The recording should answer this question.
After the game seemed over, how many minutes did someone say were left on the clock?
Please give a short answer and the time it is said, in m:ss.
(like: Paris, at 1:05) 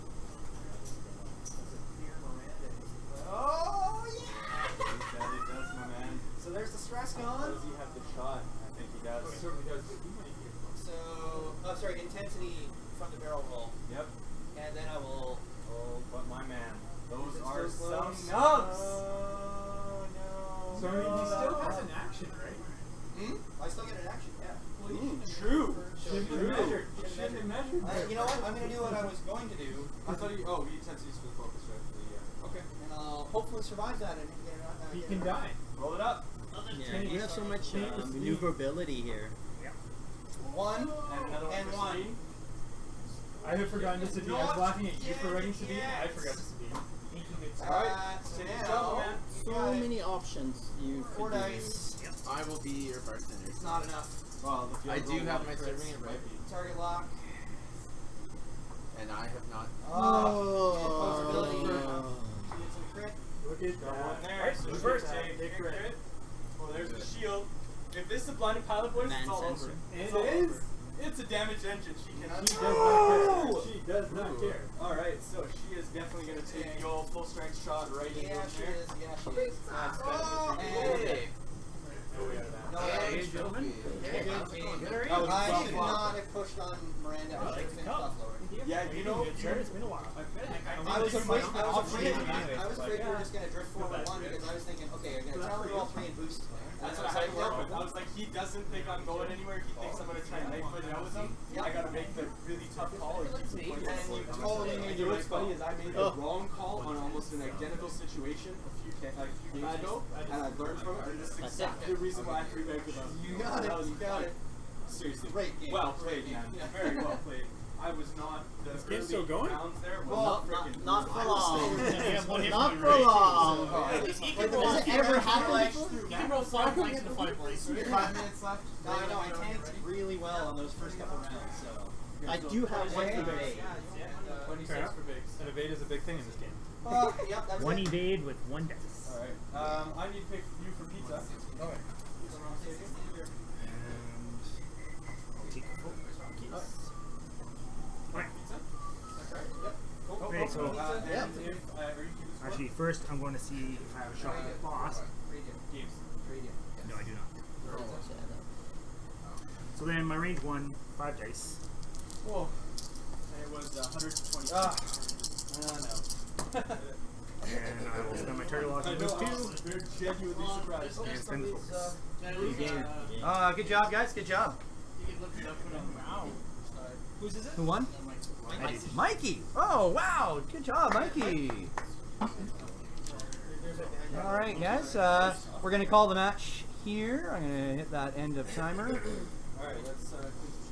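5, at 2:07.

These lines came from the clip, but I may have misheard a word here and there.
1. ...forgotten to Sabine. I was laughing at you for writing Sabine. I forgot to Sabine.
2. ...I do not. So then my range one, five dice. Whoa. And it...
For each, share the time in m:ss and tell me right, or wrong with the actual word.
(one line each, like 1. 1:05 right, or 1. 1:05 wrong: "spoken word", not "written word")
1. 0:43 right
2. 2:36 right.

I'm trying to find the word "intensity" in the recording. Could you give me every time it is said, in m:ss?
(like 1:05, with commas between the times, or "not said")
0:11, 0:30.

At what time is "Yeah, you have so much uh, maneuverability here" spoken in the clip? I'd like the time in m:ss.
0:36.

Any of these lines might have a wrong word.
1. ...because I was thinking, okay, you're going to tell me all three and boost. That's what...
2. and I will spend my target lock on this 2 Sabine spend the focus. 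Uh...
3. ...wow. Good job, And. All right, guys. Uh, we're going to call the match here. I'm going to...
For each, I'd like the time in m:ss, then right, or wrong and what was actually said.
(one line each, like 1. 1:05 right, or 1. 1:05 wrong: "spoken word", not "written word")
1. 1:34 right
2. 2:47 wrong: "And", not "Sabine"
3. 2:59 wrong: "Mikey", not "And".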